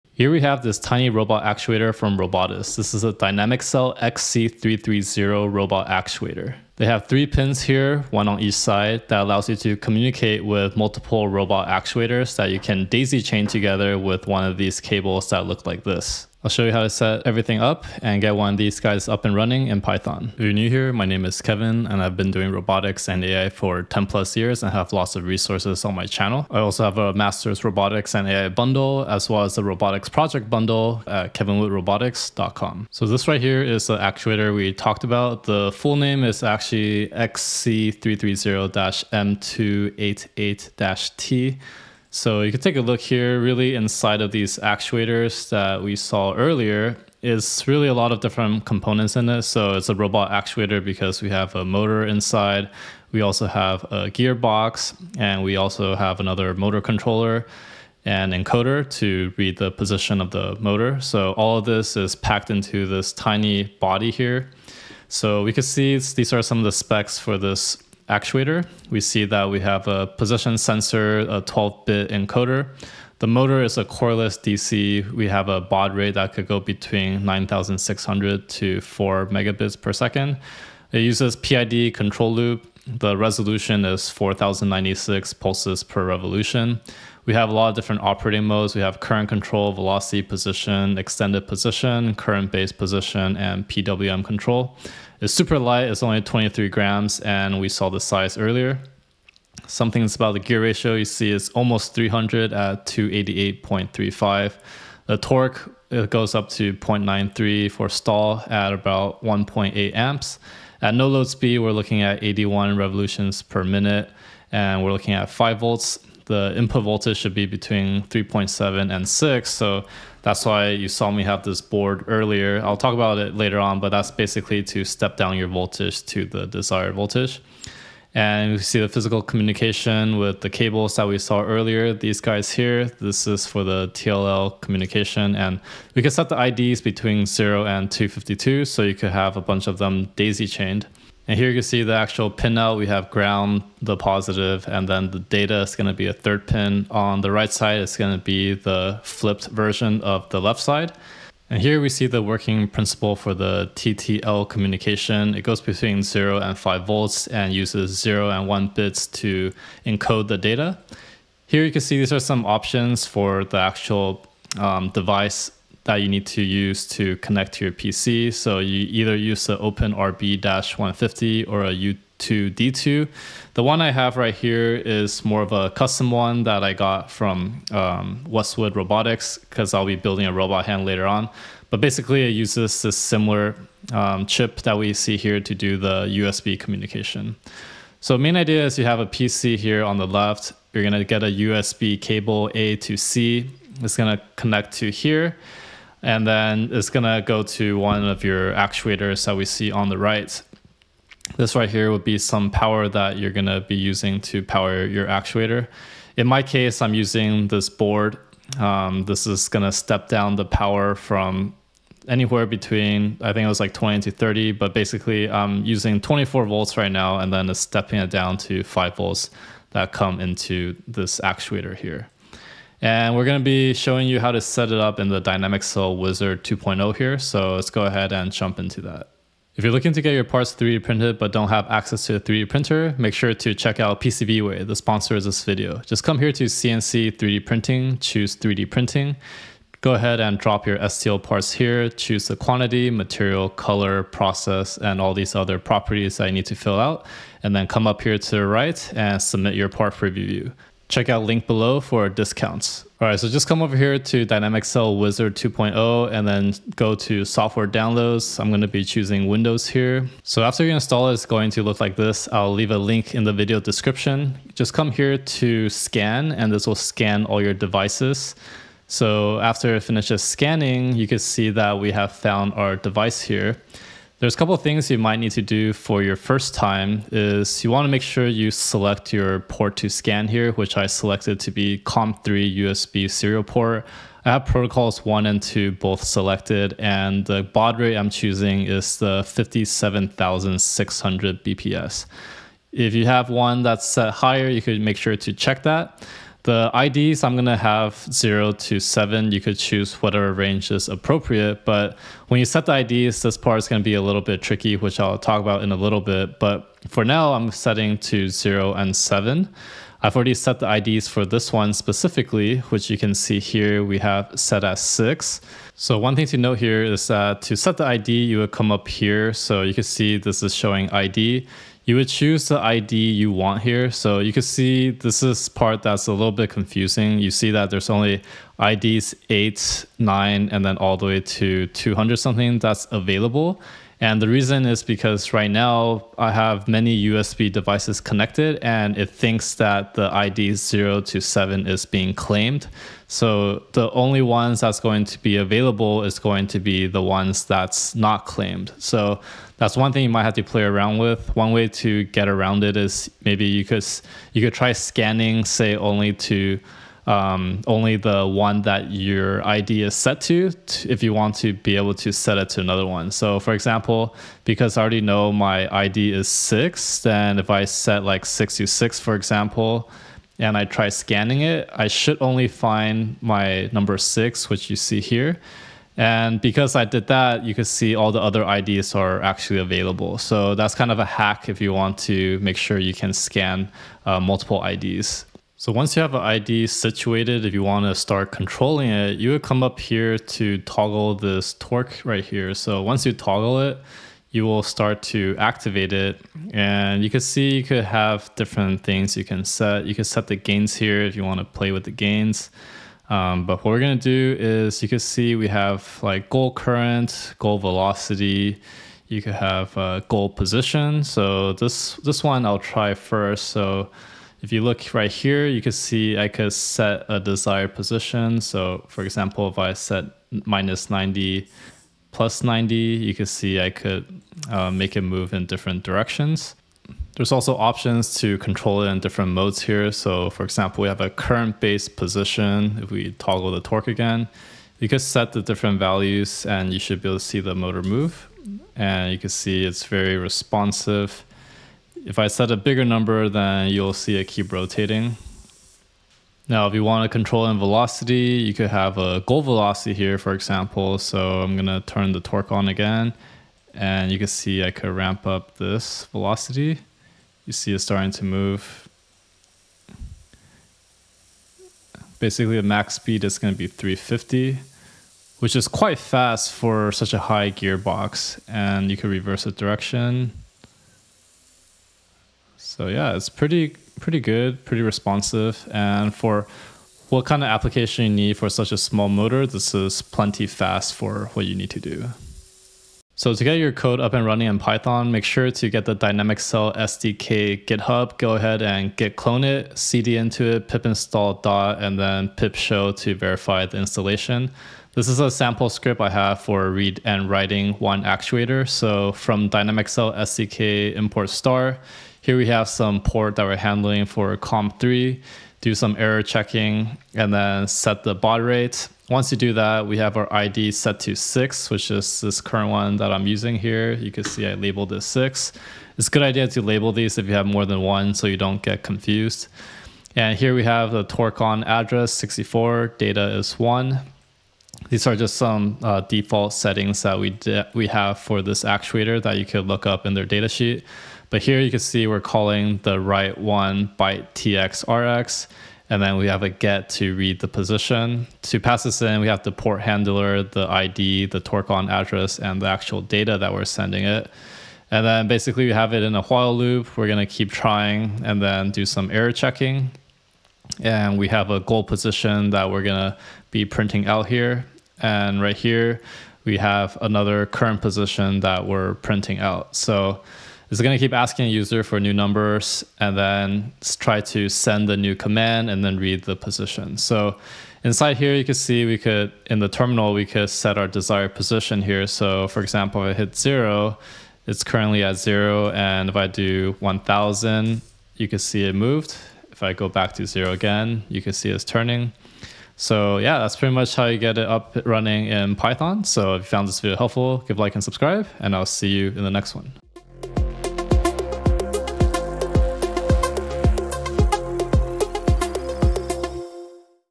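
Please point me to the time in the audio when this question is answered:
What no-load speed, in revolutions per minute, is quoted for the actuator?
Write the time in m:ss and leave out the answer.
1:52.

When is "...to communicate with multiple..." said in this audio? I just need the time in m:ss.
0:09.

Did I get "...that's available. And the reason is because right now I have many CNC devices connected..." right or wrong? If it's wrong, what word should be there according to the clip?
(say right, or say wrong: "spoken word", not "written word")
wrong: "USB", not "CNC".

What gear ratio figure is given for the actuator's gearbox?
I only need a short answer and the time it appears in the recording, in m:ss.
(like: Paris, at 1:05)
288.35, at 1:42.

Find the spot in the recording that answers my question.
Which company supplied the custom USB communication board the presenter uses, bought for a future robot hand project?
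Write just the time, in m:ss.
2:58.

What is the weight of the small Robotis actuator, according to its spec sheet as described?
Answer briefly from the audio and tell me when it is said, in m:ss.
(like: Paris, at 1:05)
23 grams, at 1:36.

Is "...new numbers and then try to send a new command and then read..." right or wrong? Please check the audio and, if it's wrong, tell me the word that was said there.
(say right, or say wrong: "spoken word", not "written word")
right.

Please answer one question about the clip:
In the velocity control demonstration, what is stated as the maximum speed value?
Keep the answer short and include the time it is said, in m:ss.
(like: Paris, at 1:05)
350, at 7:43.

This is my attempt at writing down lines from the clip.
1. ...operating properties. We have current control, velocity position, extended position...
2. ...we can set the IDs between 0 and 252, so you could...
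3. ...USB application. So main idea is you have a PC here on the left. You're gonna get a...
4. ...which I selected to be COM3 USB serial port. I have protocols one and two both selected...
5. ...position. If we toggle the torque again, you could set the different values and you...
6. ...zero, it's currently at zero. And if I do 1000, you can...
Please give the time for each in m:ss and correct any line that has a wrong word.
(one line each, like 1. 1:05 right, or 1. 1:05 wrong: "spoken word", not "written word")
1. 1:28 wrong: "modes", not "properties"
2. 2:15 right
3. 3:06 wrong: "communication", not "application"
4. 4:40 right
5. 7:11 right
6. 9:33 right.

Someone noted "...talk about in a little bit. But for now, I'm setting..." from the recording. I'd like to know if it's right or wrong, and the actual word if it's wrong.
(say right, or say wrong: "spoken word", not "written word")
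right.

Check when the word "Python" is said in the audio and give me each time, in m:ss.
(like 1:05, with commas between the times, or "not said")
0:19, 8:04, 9:45.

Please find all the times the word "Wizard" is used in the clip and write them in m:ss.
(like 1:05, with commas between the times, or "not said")
3:45, 4:14.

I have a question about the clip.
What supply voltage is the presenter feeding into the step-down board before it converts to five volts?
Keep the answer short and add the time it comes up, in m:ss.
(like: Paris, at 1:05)
24 volts, at 3:36.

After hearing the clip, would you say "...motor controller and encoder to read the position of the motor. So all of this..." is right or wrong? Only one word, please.
right.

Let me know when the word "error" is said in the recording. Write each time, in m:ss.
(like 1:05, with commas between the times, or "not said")
8:25, 9:09.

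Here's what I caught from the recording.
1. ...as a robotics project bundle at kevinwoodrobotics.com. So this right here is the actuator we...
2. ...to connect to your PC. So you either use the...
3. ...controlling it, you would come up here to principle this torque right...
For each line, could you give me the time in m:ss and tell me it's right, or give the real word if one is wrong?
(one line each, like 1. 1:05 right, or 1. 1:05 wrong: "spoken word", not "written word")
1. 0:29 right
2. 2:46 right
3. 6:28 wrong: "toggle", not "principle".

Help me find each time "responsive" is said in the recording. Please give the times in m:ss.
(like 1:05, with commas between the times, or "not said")
7:20, 7:54.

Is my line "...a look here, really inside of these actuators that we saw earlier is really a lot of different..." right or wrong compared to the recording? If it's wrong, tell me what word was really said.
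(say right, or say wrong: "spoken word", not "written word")
right.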